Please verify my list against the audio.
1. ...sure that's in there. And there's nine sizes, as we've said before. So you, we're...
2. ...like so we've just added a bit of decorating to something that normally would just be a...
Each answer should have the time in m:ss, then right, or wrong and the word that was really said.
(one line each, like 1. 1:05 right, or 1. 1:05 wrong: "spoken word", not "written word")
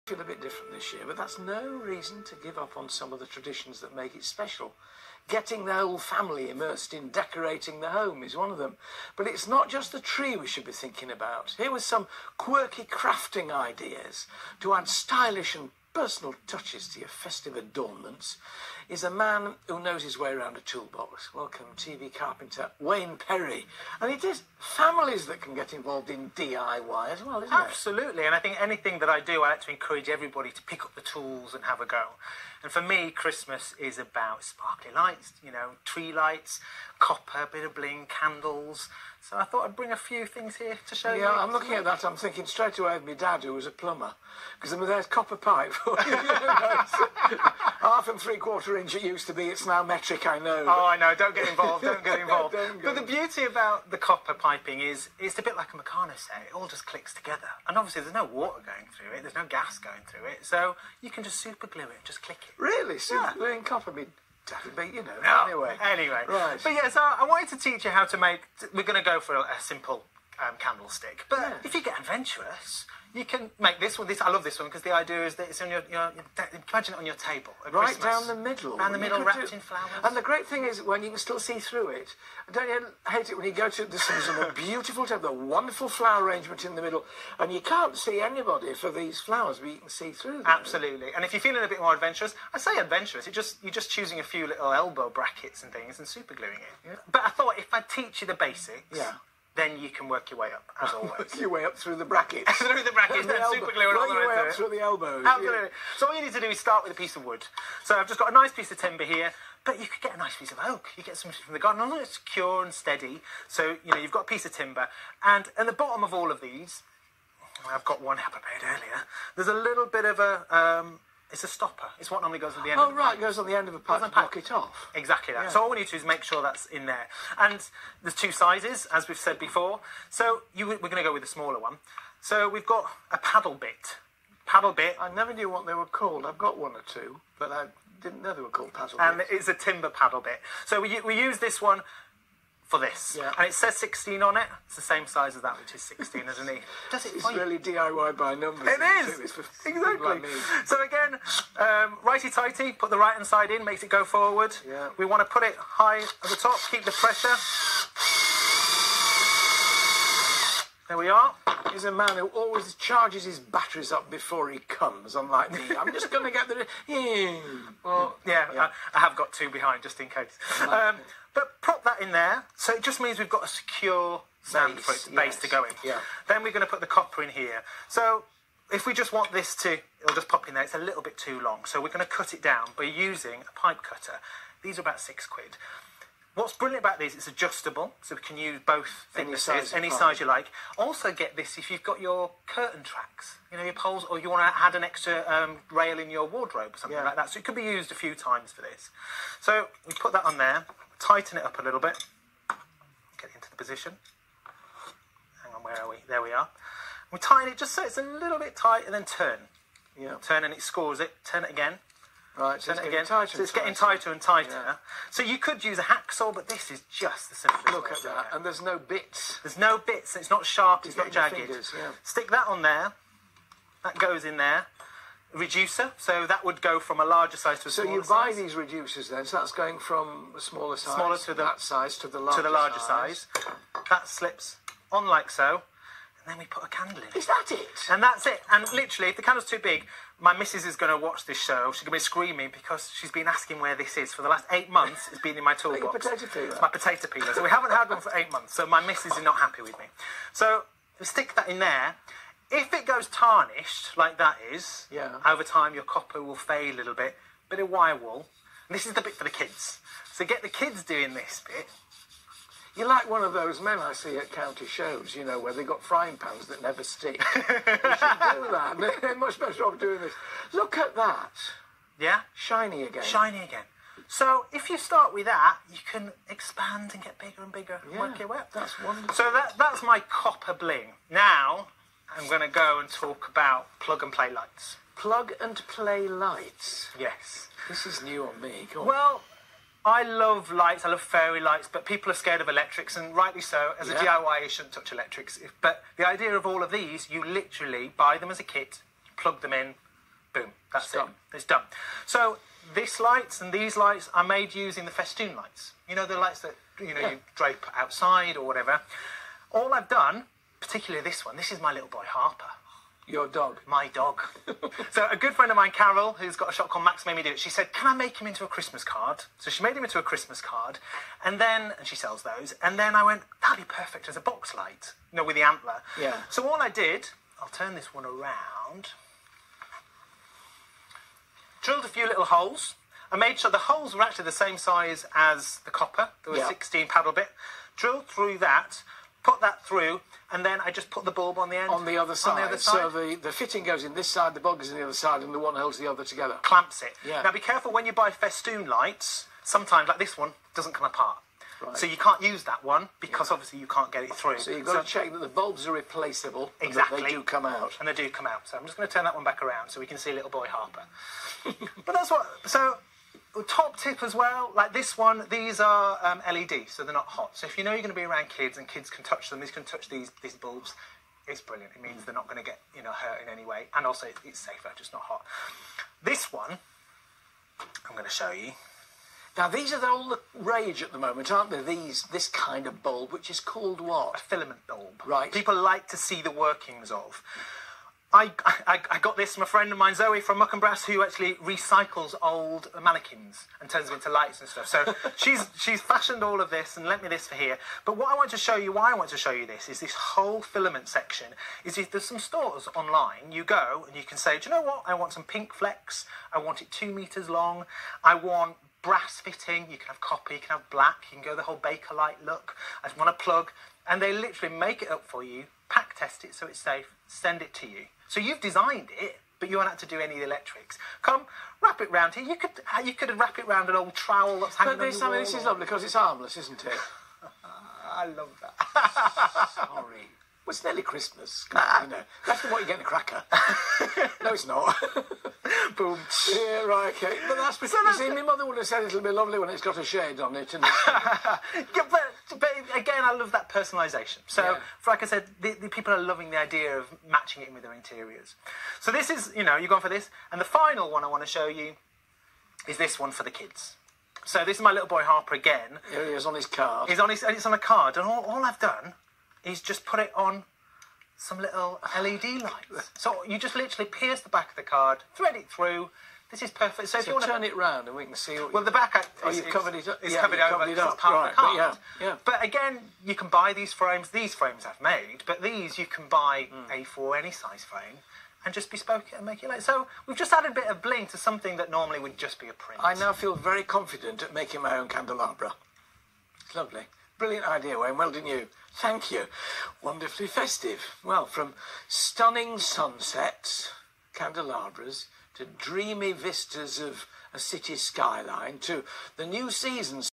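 1. 2:06 wrong: "two", not "nine"
2. 7:59 wrong: "bling", not "decorating".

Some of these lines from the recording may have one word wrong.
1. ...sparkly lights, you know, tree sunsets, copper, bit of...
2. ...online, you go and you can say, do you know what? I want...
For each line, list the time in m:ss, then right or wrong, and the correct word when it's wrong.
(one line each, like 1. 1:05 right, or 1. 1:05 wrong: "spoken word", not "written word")
1. 0:34 wrong: "lights", not "sunsets"
2. 6:42 right.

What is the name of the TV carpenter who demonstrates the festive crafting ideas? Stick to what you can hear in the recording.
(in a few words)
Wayne Perrey.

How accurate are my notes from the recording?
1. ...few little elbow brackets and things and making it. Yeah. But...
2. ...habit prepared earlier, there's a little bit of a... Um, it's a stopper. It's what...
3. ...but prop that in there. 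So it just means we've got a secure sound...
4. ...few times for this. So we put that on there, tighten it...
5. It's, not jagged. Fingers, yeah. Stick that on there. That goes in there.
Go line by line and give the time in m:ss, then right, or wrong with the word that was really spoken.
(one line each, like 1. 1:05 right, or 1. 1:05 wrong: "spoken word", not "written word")
1. 1:34 wrong: "supergluing", not "making"
2. 1:58 right
3. 2:51 right
4. 3:17 right
5. 3:40 right.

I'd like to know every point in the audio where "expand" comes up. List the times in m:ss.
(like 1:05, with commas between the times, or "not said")
4:36.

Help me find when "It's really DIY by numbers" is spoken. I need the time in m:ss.
2:27.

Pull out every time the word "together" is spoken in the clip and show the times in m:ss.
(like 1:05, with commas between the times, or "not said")
0:57, 5:46.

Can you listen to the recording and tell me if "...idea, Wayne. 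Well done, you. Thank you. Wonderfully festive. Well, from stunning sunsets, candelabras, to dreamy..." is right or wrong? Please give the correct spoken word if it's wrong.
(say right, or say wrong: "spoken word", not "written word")
right.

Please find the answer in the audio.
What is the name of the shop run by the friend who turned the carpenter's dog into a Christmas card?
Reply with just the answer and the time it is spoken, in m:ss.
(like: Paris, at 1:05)
Max Made Me Do It, at 5:16.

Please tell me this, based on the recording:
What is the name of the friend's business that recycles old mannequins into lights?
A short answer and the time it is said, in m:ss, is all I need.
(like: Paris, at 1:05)
Muck and Brass, at 6:30.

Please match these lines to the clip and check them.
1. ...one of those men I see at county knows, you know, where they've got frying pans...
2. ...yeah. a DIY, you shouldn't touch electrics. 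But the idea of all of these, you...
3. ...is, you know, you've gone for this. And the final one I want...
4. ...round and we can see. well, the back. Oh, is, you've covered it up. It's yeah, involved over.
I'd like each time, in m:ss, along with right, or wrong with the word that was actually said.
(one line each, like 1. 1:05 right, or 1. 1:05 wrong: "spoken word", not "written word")
1. 4:23 wrong: "shows", not "knows"
2. 4:53 right
3. 7:29 right
4. 7:47 wrong: "covered", not "involved".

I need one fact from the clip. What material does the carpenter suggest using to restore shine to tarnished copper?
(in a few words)
Wire wool.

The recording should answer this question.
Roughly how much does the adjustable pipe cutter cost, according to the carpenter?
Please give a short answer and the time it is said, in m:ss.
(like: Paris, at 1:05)
About six quid, at 3:04.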